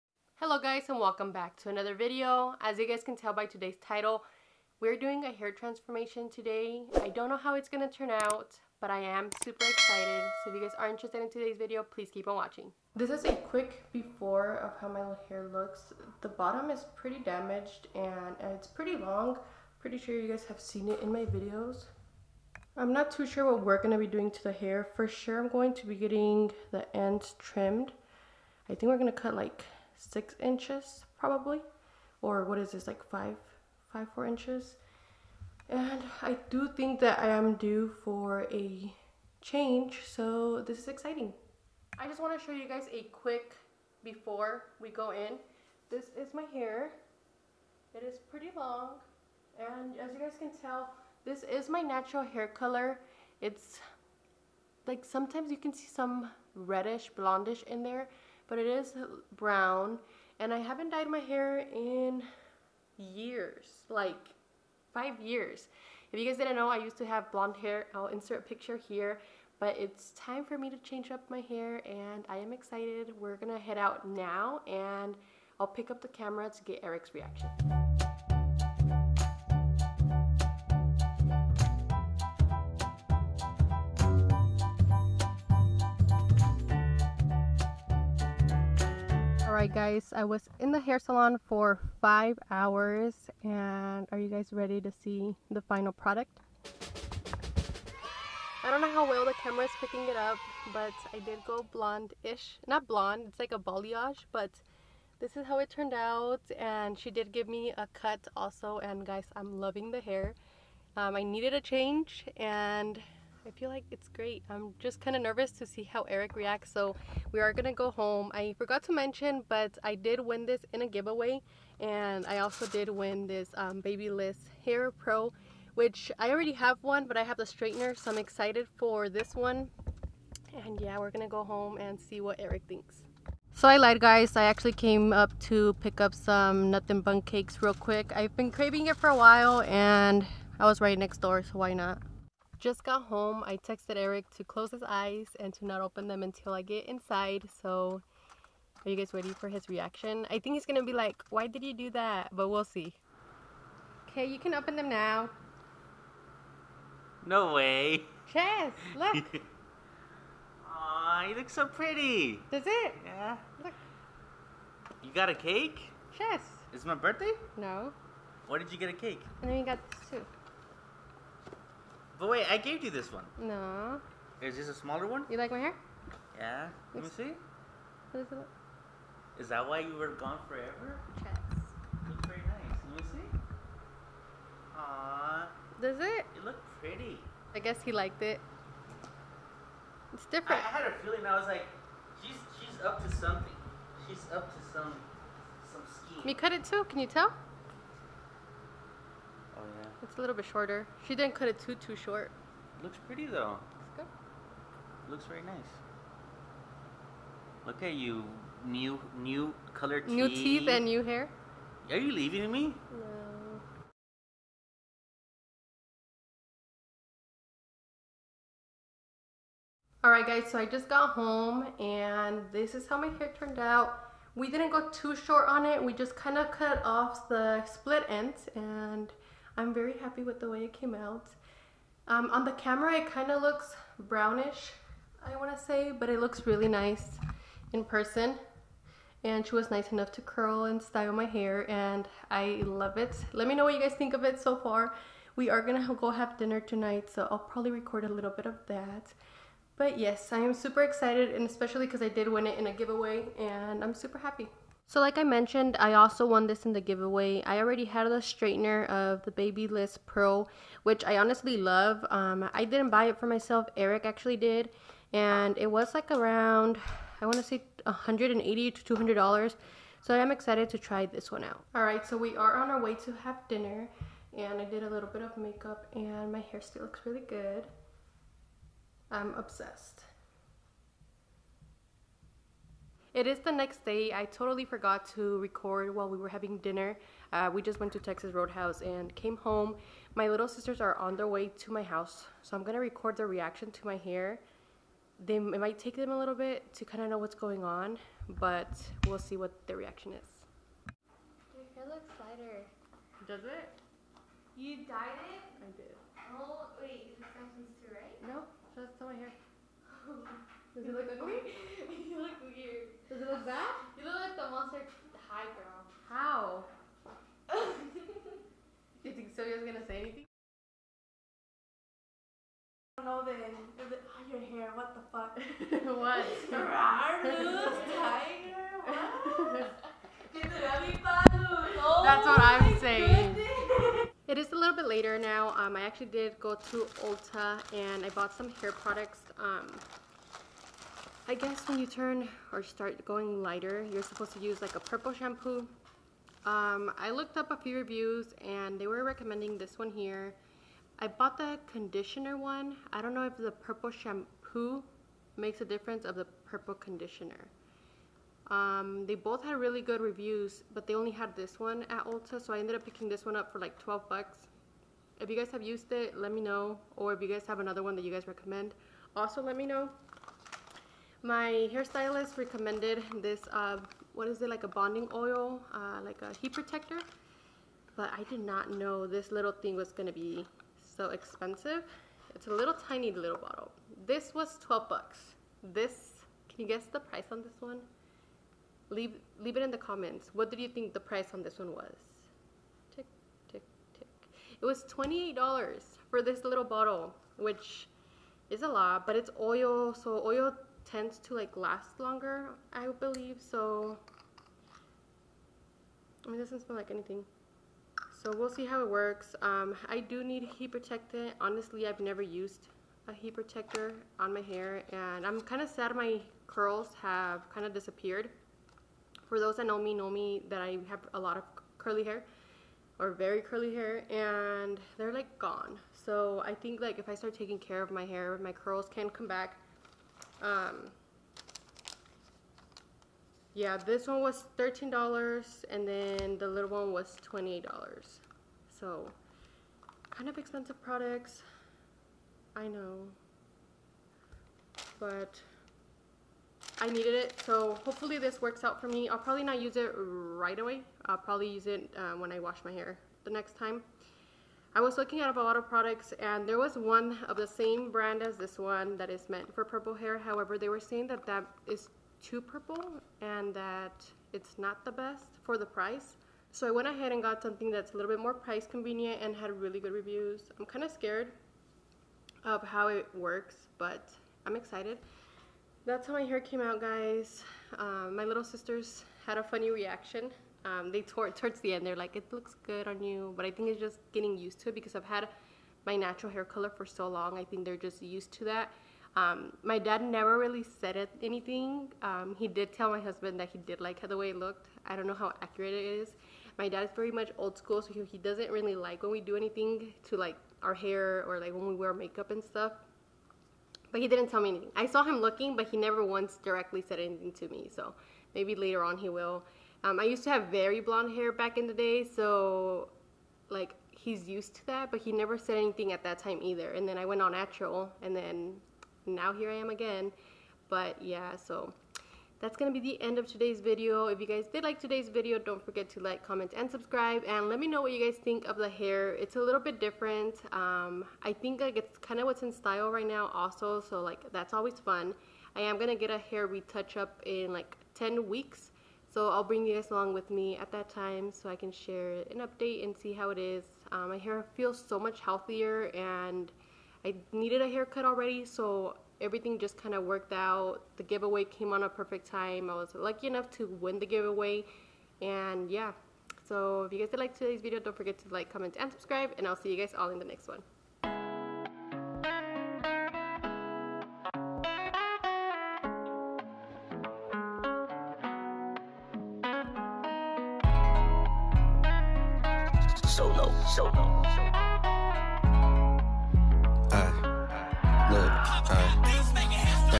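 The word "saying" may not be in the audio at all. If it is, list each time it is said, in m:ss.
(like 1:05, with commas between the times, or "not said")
5:32, 7:40.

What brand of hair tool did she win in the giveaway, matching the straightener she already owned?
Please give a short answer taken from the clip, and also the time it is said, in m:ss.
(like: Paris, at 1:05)
Babyliss Pro, at 4:19.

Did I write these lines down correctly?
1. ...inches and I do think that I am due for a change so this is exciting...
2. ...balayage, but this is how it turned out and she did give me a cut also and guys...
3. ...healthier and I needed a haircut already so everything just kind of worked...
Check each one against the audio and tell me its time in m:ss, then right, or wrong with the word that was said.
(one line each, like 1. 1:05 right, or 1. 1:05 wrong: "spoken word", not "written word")
1. 0:34 right
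2. 1:43 right
3. 9:05 right.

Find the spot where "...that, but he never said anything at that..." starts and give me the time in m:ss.
8:34.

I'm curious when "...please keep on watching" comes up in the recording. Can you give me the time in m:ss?
0:11.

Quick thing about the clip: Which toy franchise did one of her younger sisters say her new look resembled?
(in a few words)
Monster High.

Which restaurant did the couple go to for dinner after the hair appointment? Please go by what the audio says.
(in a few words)
Texas Roadhouse.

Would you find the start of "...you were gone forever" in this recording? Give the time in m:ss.
2:59.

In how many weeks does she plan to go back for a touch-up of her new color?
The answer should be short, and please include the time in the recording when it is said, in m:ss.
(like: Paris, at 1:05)
10, at 8:57.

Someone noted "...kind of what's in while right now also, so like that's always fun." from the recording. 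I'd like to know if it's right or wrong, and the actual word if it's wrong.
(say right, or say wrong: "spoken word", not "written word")
wrong: "style", not "while".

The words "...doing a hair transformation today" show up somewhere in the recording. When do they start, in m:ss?
0:04.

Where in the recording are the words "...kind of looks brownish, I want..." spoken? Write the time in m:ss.
3:53.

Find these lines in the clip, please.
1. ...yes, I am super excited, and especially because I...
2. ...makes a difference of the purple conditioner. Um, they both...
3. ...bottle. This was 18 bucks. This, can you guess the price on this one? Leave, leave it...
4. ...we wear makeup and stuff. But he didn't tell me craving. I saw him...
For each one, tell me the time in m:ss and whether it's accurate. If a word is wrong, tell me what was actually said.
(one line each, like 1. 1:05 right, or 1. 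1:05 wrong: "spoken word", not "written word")
1. 4:09 right
2. 5:55 right
3. 6:23 wrong: "12", not "18"
4. 8:21 wrong: "anything", not "craving".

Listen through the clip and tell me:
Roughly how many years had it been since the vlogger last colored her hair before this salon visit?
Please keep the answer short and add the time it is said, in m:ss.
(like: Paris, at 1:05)
5 years, at 1:03.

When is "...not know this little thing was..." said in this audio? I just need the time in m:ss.
6:18.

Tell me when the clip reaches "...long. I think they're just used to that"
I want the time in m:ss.
8:07.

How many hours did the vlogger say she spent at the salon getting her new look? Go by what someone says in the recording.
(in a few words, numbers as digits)
5.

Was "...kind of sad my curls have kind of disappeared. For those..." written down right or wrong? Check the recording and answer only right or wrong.
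right.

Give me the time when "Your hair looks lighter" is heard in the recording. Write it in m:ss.
5:01.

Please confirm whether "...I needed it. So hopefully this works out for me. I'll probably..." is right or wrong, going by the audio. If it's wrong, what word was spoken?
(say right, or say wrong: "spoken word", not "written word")
right.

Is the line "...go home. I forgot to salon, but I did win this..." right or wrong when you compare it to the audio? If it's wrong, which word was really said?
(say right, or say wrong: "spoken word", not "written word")
wrong: "mention", not "salon".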